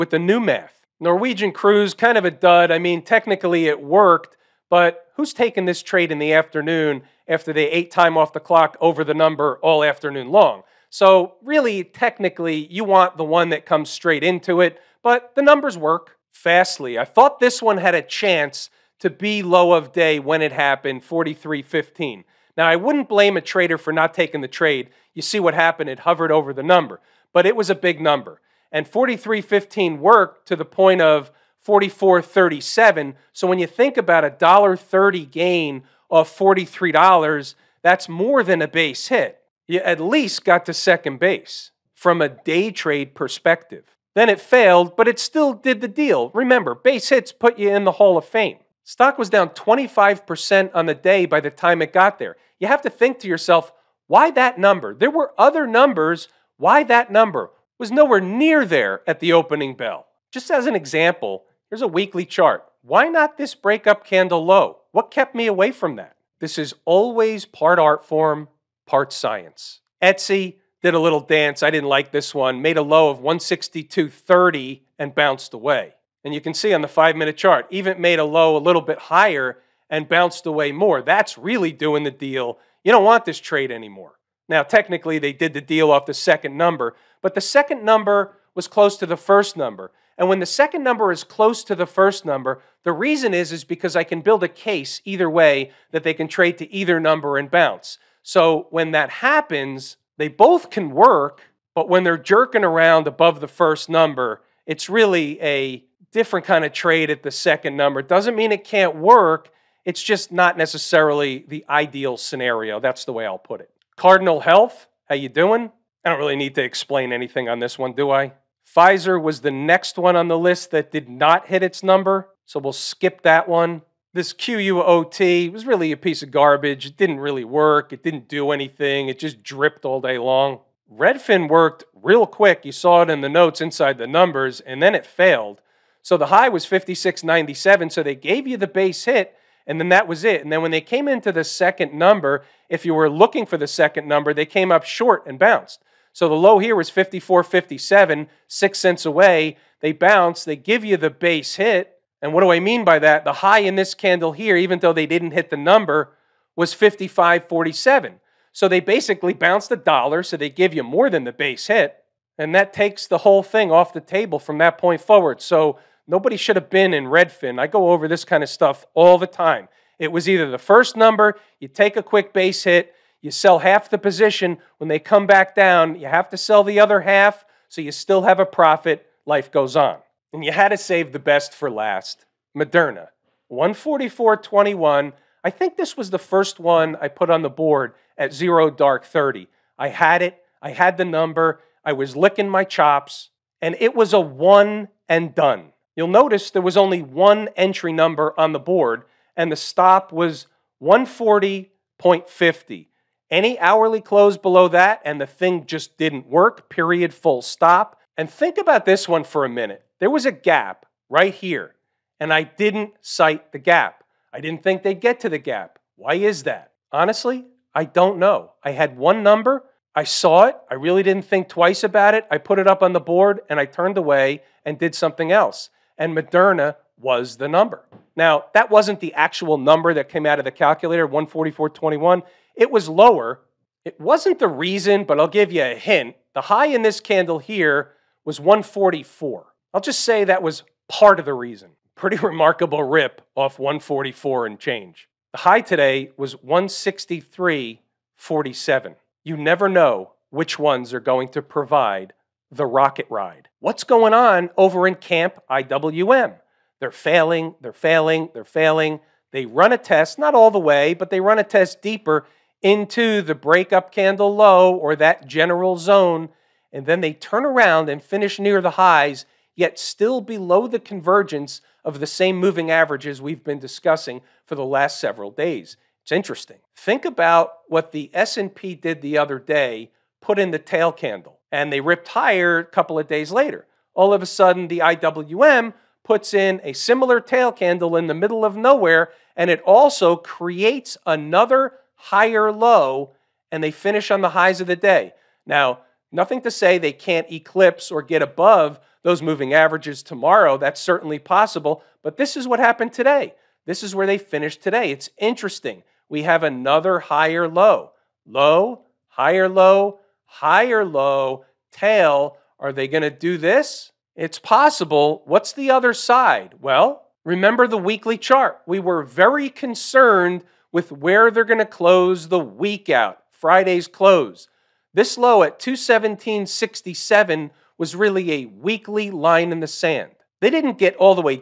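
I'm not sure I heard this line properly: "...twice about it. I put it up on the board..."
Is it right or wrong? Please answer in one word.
right.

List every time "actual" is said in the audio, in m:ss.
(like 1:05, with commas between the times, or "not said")
3:49.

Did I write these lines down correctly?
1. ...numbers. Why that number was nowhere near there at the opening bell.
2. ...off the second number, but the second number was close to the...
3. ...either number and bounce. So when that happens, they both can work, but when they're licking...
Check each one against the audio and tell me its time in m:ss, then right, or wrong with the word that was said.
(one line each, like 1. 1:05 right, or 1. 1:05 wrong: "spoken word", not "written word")
1. 0:55 right
2. 1:25 right
3. 1:36 wrong: "jerking", not "licking".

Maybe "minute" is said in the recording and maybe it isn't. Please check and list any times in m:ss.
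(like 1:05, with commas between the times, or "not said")
1:17, 3:29.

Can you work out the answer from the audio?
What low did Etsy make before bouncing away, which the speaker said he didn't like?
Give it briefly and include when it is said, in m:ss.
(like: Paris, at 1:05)
162.30, at 1:13.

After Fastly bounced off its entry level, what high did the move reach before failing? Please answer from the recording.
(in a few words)
44.37.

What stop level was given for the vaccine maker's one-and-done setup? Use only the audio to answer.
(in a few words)
140.50.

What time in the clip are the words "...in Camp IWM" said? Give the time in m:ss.
4:14.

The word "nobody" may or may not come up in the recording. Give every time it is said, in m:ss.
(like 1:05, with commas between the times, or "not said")
2:46.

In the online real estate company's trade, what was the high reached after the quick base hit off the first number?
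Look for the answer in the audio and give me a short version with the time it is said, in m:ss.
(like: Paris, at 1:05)
56.97, at 2:16.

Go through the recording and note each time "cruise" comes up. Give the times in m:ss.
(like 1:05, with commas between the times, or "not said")
0:01.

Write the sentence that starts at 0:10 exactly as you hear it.
So really, technically, you want the one that comes straight into it, but the numbers work.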